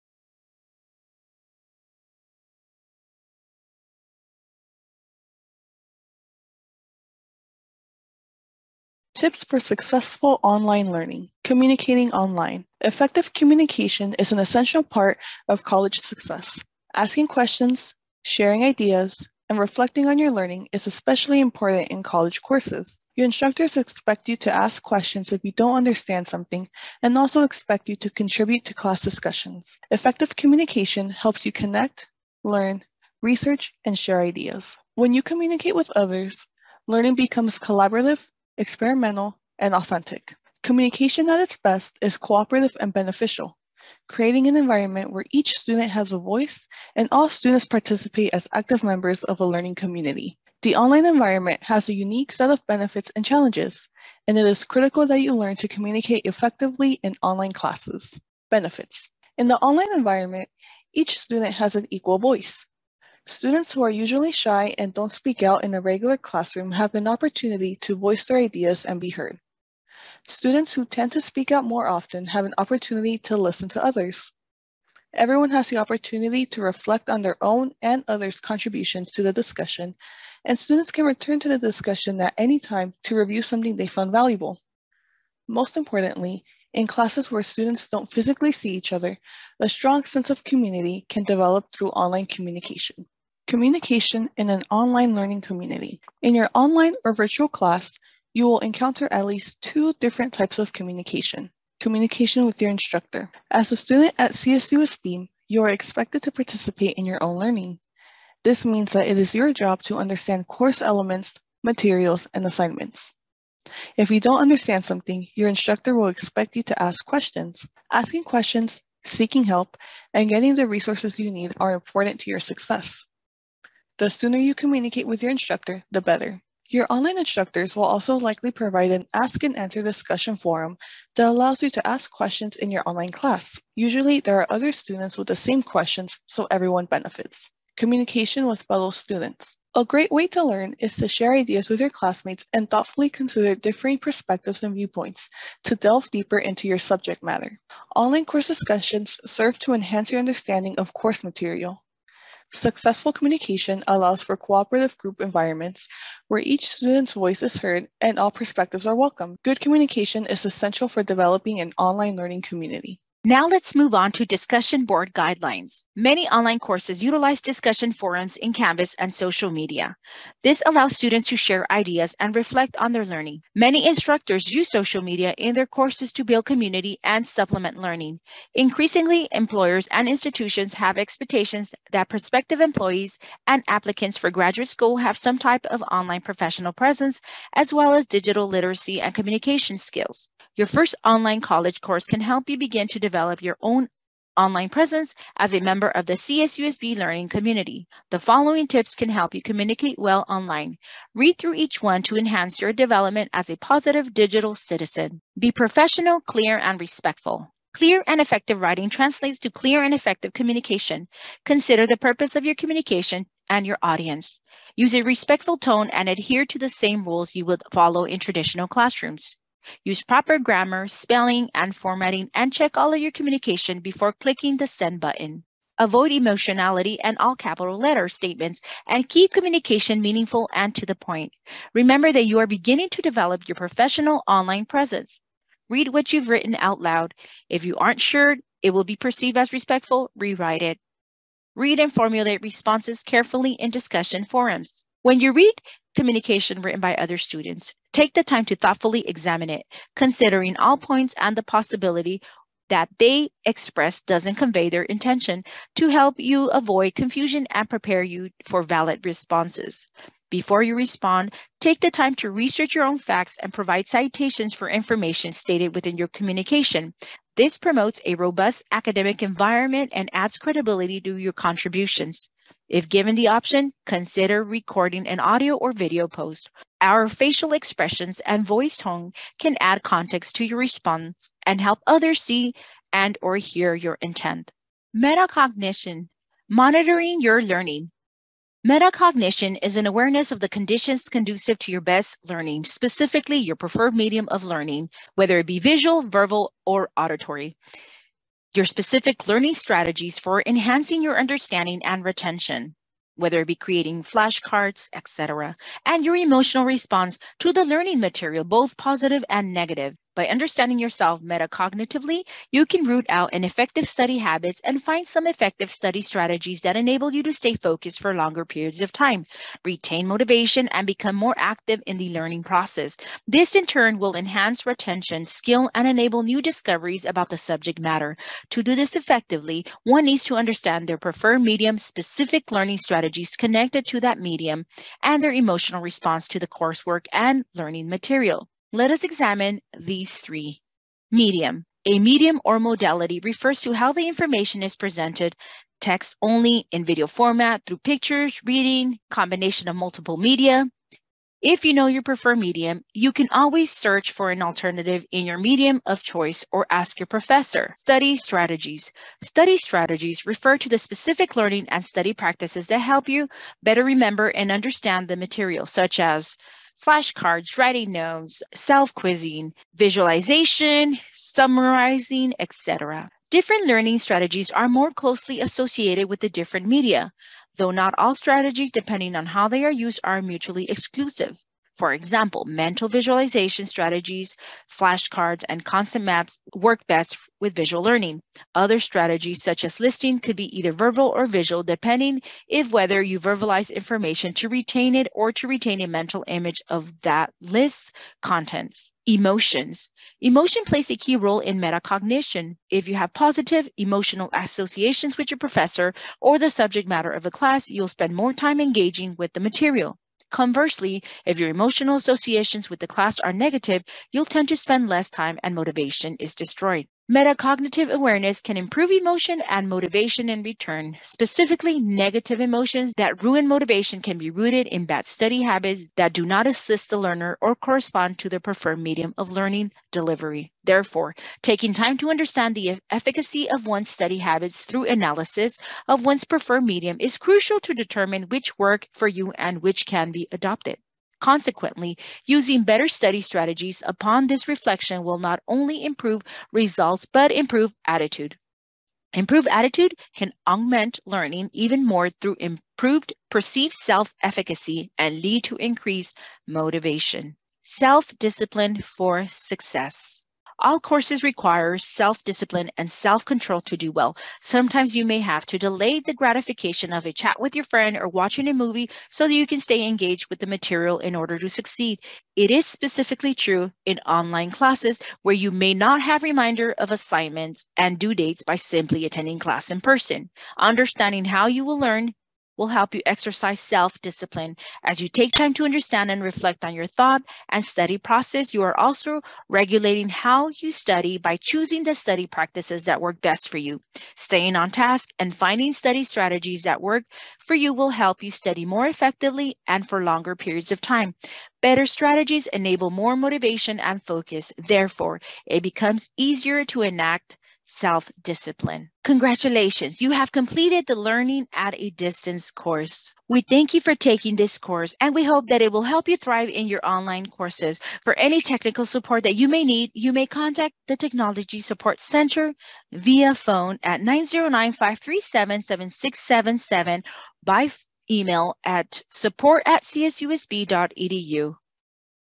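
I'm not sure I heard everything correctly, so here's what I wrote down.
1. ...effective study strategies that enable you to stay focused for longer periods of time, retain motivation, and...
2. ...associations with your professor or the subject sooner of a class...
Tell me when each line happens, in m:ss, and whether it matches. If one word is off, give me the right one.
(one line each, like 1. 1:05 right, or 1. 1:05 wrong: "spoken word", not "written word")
1. 5:15 right
2. 6:44 wrong: "matter", not "sooner".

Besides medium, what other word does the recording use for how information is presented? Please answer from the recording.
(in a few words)
modality.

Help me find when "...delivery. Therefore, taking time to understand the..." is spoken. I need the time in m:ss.
7:09.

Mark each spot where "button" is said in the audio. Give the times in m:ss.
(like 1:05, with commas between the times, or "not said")
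3:44.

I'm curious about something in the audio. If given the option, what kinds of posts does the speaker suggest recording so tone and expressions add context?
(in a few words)
audio or video.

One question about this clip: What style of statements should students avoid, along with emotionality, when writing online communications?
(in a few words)
all capital letter statements.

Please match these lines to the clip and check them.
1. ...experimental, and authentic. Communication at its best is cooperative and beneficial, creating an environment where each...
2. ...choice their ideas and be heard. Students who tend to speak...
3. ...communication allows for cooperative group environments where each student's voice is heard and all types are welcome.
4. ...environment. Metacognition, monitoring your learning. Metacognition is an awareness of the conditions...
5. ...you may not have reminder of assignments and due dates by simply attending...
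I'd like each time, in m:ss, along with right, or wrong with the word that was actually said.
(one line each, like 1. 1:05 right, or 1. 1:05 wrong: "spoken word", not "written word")
1. 0:38 right
2. 1:07 wrong: "voice", not "choice"
3. 2:33 wrong: "perspectives", not "types"
4. 4:43 wrong: "intent", not "environment"
5. 7:55 right.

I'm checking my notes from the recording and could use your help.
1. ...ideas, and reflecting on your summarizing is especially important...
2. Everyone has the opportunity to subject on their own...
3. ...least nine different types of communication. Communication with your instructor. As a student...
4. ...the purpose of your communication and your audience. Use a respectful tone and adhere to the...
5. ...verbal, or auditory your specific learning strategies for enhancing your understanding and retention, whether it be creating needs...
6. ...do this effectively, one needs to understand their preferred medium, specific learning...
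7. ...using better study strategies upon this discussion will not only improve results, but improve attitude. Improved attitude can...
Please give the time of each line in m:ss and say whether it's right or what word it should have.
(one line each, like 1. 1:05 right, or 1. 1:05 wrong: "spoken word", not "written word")
1. 0:18 wrong: "learning", not "summarizing"
2. 1:15 wrong: "reflect", not "subject"
3. 1:39 wrong: "two", not "nine"
4. 3:31 right
5. 4:56 wrong: "flashcards", not "needs"
6. 5:28 right
7. 7:22 wrong: "reflection", not "discussion".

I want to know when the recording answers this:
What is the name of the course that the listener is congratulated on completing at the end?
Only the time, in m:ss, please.
8:30.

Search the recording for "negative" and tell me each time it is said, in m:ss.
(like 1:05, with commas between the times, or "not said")
5:09, 6:53, 7:01.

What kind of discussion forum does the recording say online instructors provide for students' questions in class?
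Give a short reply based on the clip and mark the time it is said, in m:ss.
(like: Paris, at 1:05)
ask and answer, at 2:09.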